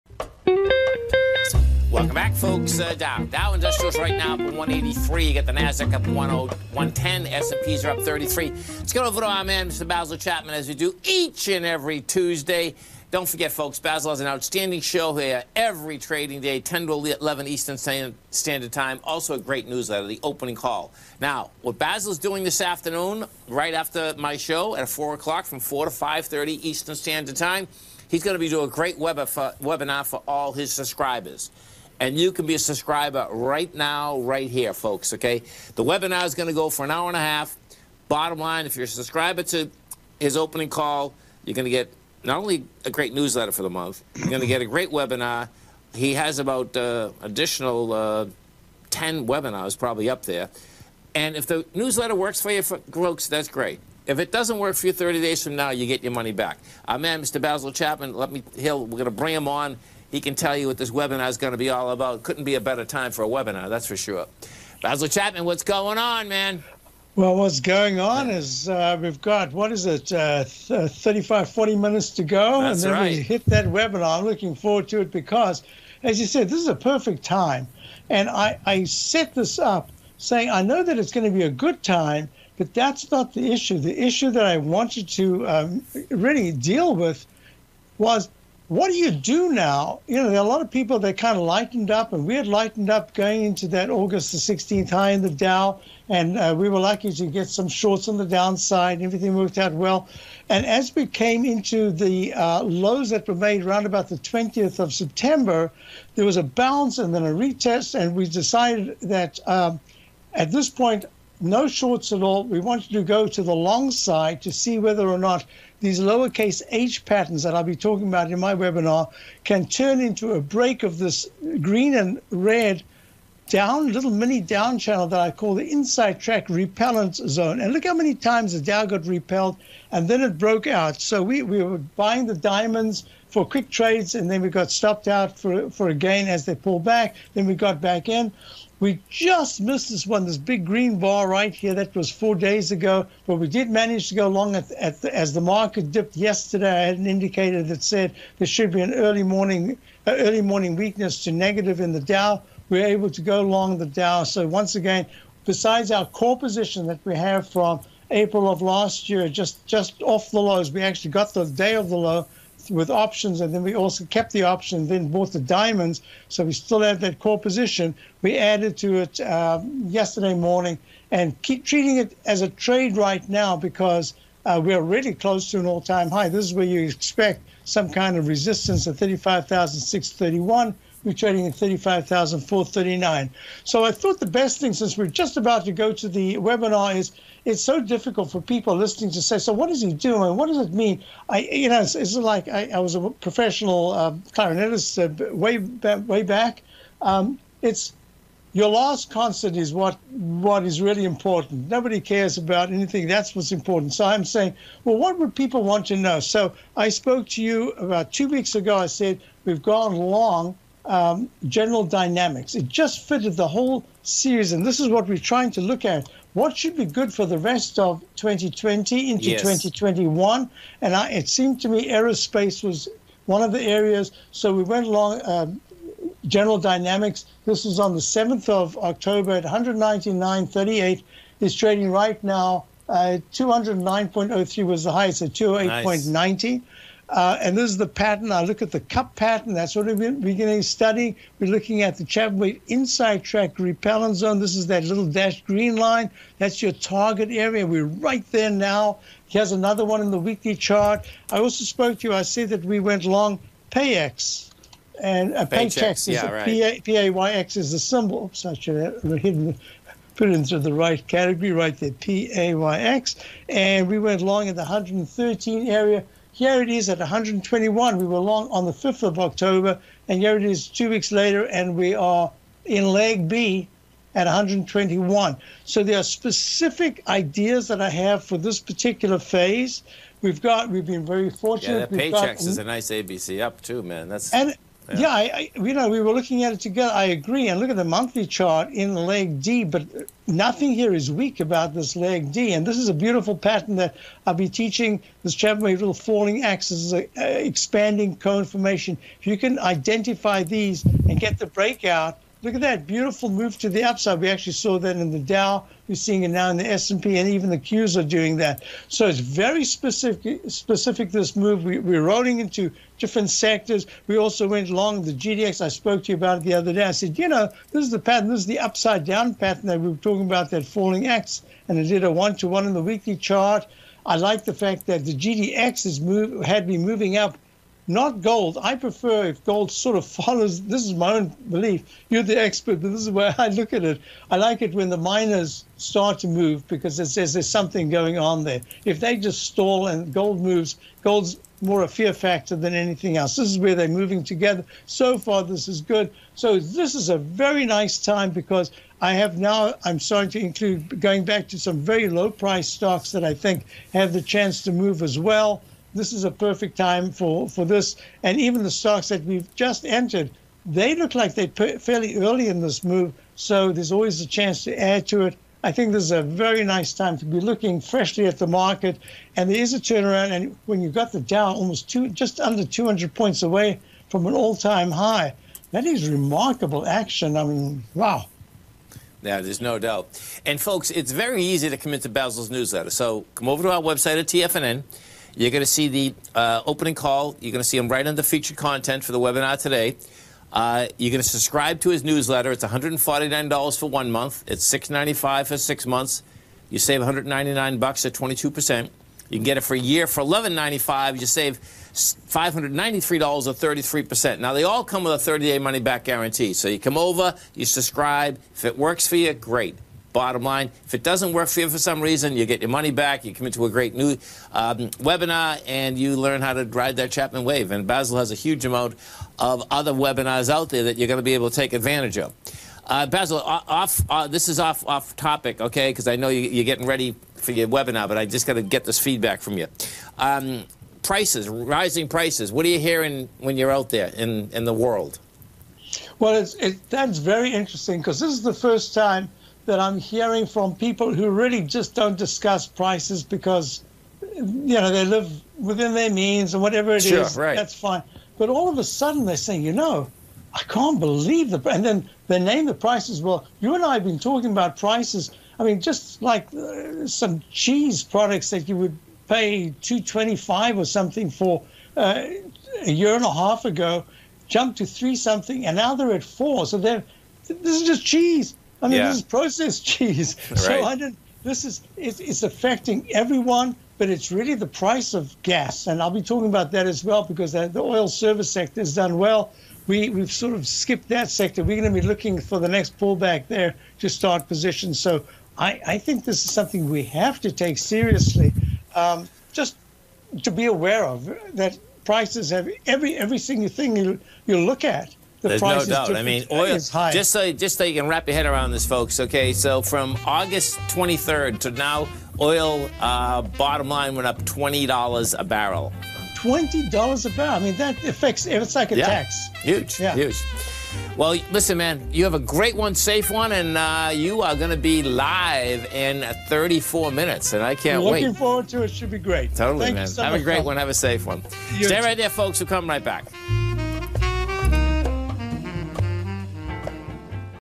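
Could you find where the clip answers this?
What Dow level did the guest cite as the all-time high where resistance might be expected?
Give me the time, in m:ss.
2:58.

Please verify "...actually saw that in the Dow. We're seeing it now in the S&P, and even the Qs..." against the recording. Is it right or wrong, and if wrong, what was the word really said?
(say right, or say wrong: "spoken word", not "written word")
right.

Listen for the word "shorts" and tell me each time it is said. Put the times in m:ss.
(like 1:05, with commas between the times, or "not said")
1:37, 1:51.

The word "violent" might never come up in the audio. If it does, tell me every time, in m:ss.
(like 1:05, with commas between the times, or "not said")
not said.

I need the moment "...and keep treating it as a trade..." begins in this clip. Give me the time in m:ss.
2:51.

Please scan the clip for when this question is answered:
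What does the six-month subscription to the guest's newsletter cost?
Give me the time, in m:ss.
6:34.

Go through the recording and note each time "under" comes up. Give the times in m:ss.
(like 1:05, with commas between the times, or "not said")
6:12, 6:28.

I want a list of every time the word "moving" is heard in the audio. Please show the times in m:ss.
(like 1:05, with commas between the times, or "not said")
5:26, 5:43.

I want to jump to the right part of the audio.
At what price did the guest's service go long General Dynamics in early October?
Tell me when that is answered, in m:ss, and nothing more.
3:49.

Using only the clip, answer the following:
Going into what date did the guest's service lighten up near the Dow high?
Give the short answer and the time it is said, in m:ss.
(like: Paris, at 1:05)
August 16th, at 1:33.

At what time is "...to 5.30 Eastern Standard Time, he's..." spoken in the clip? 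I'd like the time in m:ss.
0:25.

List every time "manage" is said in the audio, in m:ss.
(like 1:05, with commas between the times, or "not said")
2:23.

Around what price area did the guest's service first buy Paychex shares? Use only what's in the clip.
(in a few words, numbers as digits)
113.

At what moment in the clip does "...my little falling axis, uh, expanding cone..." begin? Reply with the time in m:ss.
4:55.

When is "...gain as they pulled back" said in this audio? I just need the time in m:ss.
2:15.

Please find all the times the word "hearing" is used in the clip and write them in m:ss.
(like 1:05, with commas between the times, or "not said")
7:12, 7:19.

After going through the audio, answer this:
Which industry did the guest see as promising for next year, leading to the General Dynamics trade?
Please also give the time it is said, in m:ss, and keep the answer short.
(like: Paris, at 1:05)
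aerospace, at 3:41.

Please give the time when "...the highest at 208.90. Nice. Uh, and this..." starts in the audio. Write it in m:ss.
3:54.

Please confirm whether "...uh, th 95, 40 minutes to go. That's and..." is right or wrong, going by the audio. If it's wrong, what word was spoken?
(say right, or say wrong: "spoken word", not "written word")
wrong: "35", not "95".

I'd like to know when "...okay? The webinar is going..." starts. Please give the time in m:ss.
0:35.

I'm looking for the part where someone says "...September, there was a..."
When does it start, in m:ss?
1:44.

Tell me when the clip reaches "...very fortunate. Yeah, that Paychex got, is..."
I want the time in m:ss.
4:41.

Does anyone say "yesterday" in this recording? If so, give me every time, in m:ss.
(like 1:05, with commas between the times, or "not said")
2:26, 2:49.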